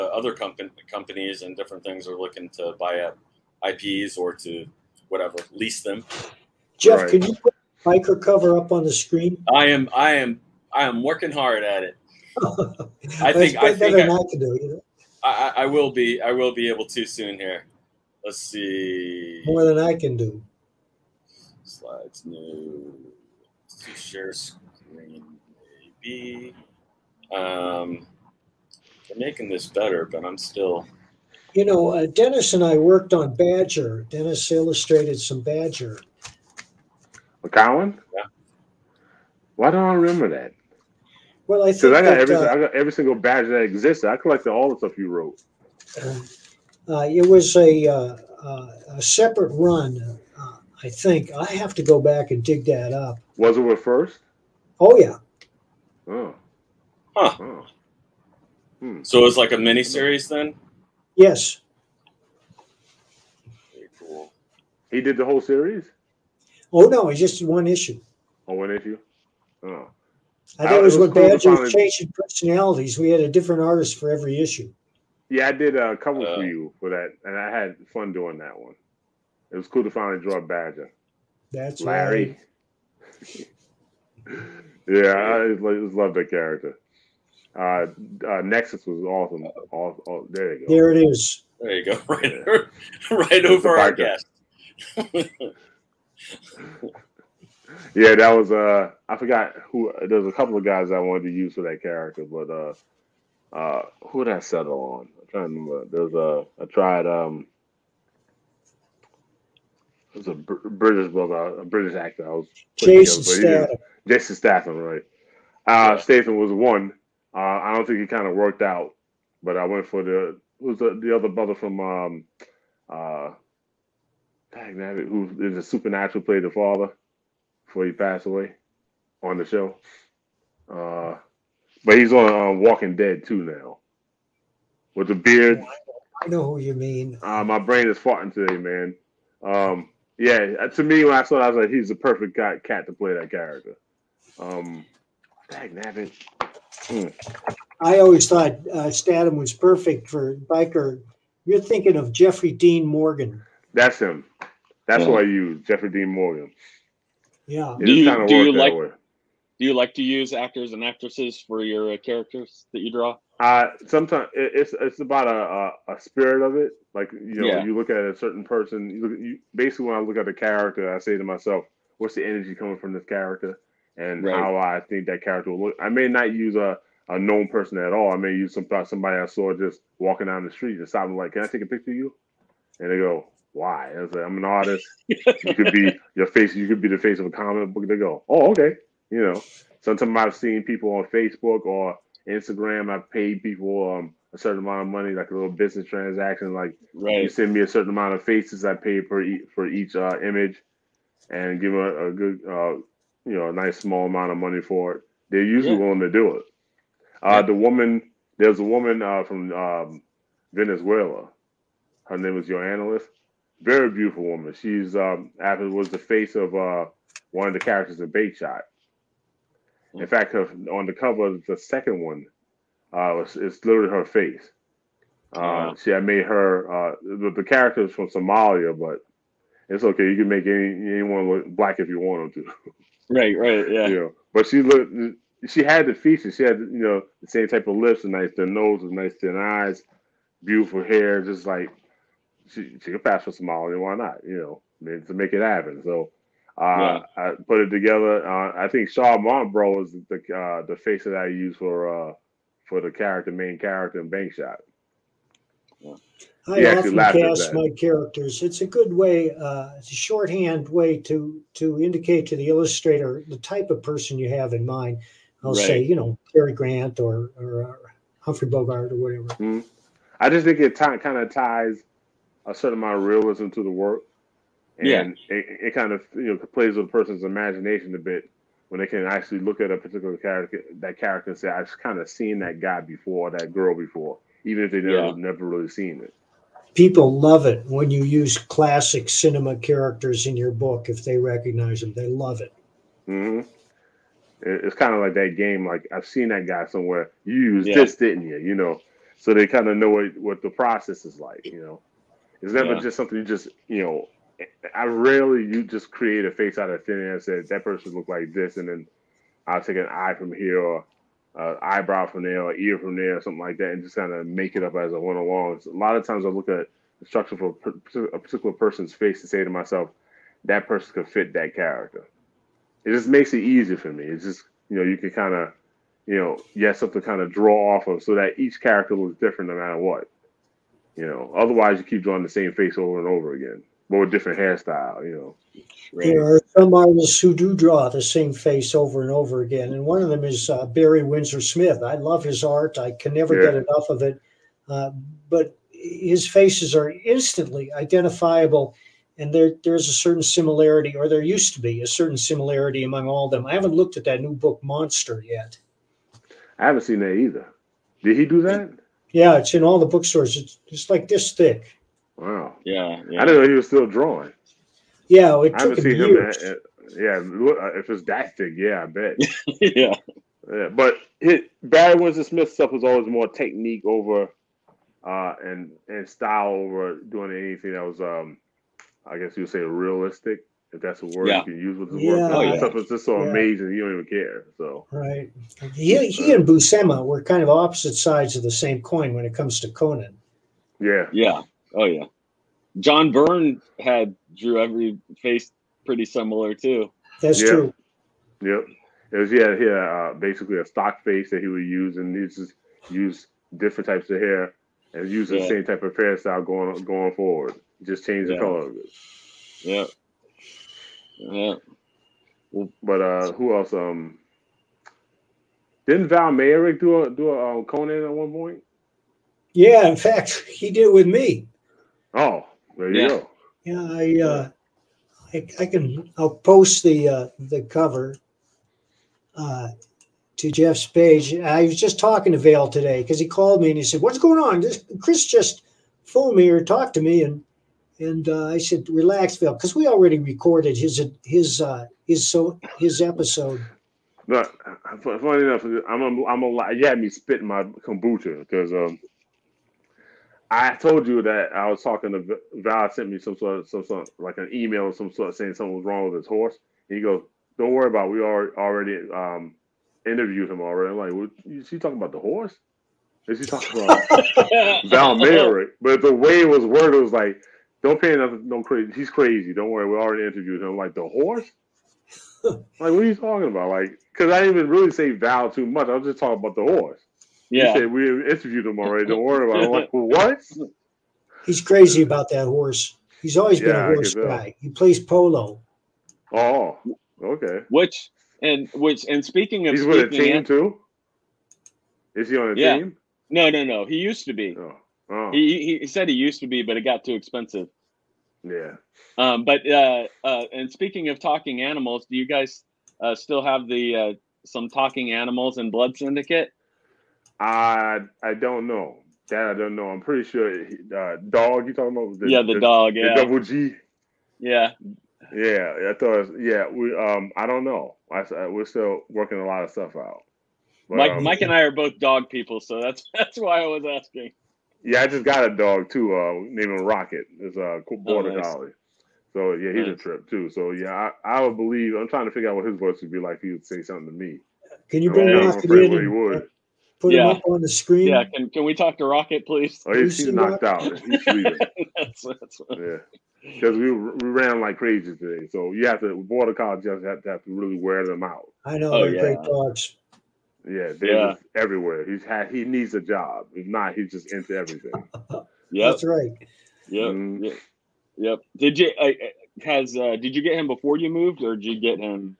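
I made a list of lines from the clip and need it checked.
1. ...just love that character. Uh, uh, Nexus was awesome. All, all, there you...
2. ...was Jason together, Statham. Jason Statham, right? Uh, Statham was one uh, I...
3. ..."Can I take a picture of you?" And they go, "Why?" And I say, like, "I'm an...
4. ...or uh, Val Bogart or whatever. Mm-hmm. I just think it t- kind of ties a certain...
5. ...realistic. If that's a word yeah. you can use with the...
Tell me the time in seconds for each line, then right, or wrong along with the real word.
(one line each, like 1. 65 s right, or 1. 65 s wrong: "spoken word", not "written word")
1. 85 s right
2. 112 s right
3. 181 s right
4. 267 s wrong: "Humphrey", not "Val"
5. 379 s right.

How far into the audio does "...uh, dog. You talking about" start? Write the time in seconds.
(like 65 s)
510 s.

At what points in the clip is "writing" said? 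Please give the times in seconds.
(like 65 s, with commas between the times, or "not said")
not said.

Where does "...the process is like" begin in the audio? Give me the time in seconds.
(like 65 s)
300 s.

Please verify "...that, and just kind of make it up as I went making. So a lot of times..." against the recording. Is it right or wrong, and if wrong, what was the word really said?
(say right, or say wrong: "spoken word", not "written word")
wrong: "along", not "making".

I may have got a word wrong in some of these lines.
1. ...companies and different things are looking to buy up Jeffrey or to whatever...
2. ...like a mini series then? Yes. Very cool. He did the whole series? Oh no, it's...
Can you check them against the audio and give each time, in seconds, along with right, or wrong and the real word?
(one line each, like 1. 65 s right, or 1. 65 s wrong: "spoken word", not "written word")
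1. 0 s wrong: "IPs", not "Jeffrey"
2. 59 s right.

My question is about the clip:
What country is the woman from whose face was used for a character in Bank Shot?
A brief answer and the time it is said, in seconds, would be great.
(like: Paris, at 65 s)
Venezuela, at 210 s.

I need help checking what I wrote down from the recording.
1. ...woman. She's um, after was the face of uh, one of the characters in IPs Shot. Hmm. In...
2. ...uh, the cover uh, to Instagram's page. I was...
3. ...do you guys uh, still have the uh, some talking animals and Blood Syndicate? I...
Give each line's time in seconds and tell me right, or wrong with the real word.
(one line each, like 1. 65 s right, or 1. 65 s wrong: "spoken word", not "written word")
1. 214 s wrong: "Bank", not "IPs"
2. 427 s wrong: "Jeff", not "Instagram"
3. 502 s right.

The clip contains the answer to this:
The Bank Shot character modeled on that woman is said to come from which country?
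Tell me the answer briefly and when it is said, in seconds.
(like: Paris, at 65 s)
Somalia, at 228 s.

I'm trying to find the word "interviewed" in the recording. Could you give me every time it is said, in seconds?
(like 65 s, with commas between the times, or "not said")
460 s, 470 s, 478 s.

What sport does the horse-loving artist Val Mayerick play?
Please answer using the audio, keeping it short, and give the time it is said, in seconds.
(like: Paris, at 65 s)
polo, at 485 s.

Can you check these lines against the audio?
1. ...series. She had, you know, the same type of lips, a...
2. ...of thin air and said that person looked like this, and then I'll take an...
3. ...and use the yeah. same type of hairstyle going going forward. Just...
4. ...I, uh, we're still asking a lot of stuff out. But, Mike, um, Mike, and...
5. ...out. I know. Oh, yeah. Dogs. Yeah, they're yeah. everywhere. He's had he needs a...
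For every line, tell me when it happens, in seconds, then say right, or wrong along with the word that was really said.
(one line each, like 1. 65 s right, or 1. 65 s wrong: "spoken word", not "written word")
1. 235 s wrong: "features", not "series"
2. 306 s right
3. 404 s right
4. 518 s wrong: "working", not "asking"
5. 548 s right.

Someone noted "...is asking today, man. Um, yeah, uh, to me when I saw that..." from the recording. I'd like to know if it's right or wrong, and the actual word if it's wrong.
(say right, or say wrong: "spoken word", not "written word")
wrong: "farting", not "asking".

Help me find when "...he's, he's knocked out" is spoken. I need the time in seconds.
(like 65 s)
539 s.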